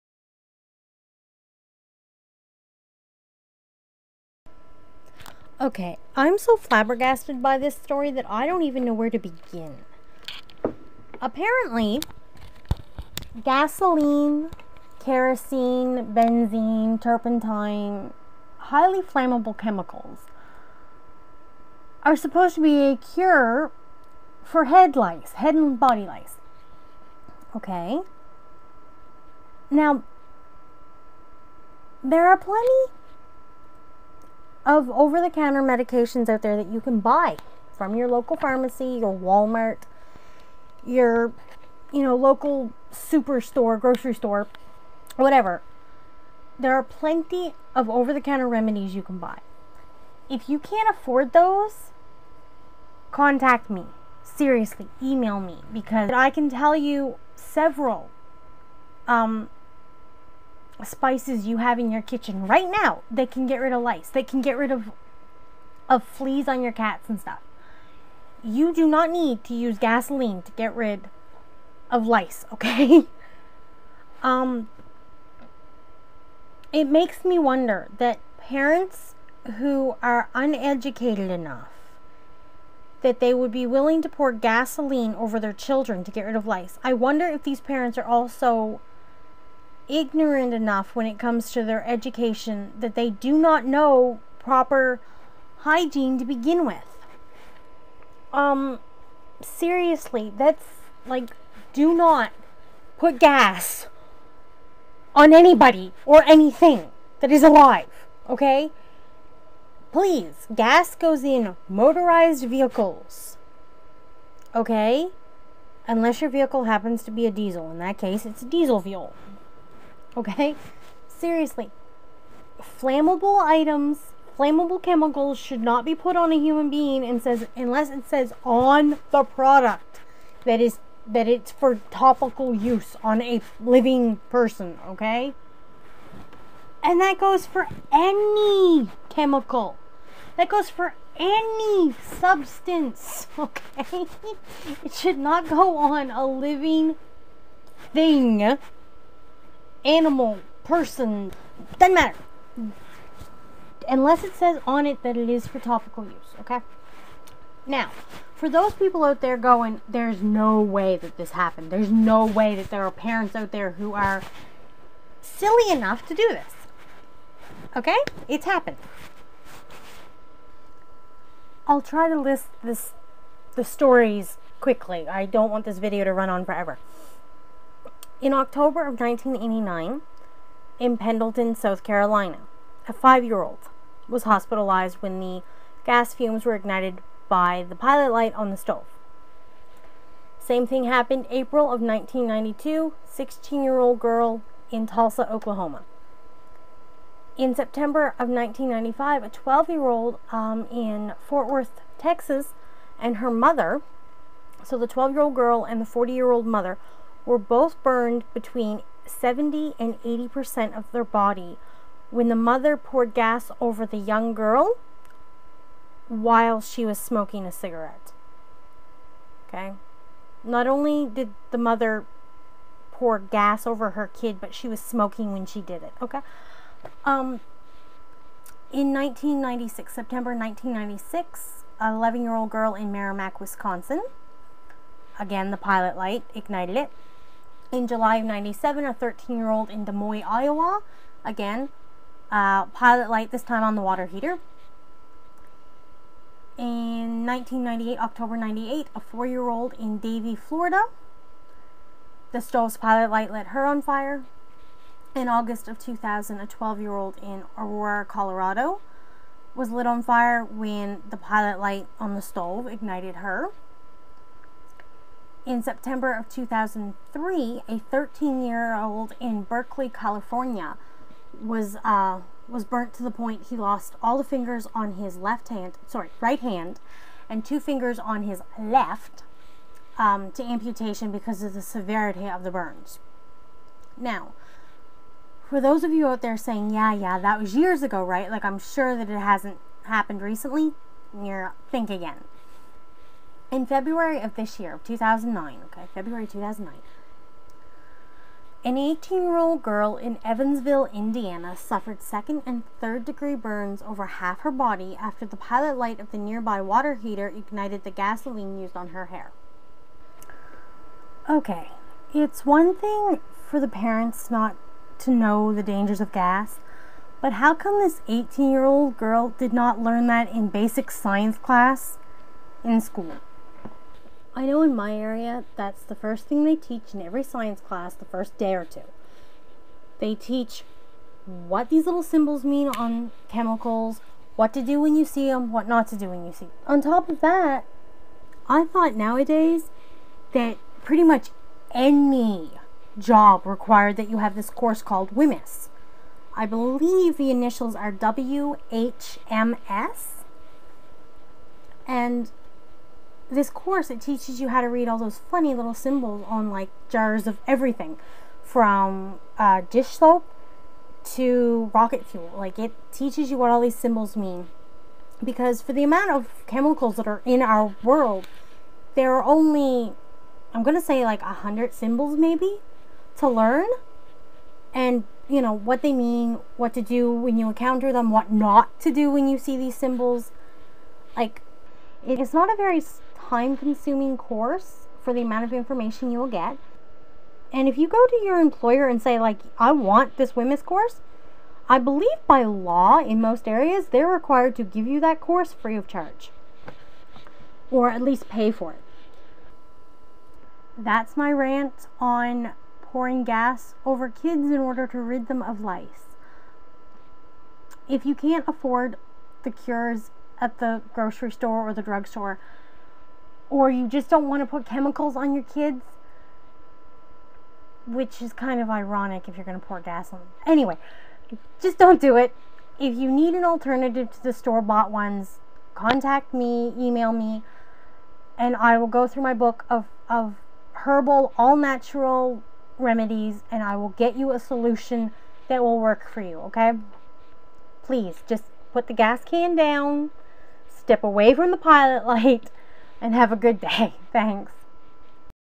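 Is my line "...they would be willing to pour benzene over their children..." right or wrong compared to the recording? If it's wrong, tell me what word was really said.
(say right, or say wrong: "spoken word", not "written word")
wrong: "gasoline", not "benzene".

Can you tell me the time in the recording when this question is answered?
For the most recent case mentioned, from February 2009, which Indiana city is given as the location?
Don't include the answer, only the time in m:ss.
5:00.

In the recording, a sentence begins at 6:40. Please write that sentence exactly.
That's my rant on pouring gas over kids in order to rid them of lice.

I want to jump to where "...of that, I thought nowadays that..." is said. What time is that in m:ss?
5:37.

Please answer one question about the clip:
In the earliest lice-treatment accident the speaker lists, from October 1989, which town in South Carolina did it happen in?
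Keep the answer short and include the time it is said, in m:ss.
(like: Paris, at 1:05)
Pendleton, at 3:00.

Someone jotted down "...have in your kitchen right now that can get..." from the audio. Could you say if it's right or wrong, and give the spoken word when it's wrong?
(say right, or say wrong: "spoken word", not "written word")
right.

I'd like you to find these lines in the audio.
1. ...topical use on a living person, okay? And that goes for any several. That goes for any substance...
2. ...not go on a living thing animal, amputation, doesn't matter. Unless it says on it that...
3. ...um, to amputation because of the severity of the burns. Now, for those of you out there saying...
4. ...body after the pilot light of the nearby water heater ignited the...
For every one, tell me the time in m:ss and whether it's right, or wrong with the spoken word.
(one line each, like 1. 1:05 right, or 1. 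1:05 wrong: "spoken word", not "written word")
1. 2:11 wrong: "chemical", not "several"
2. 2:25 wrong: "person", not "amputation"
3. 4:39 right
4. 5:04 right.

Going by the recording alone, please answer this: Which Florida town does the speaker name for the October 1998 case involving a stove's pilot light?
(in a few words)
Davie.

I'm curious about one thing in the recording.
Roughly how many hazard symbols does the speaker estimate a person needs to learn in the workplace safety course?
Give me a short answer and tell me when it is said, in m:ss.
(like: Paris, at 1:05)
100, at 6:11.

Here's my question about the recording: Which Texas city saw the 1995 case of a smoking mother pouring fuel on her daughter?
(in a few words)
Fort Worth.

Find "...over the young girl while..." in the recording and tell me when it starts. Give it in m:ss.
3:33.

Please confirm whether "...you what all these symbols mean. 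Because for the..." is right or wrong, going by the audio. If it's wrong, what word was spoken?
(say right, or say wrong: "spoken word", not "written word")
right.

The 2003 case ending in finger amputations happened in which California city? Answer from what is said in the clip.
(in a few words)
Berkeley.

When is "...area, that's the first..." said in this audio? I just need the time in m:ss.
5:24.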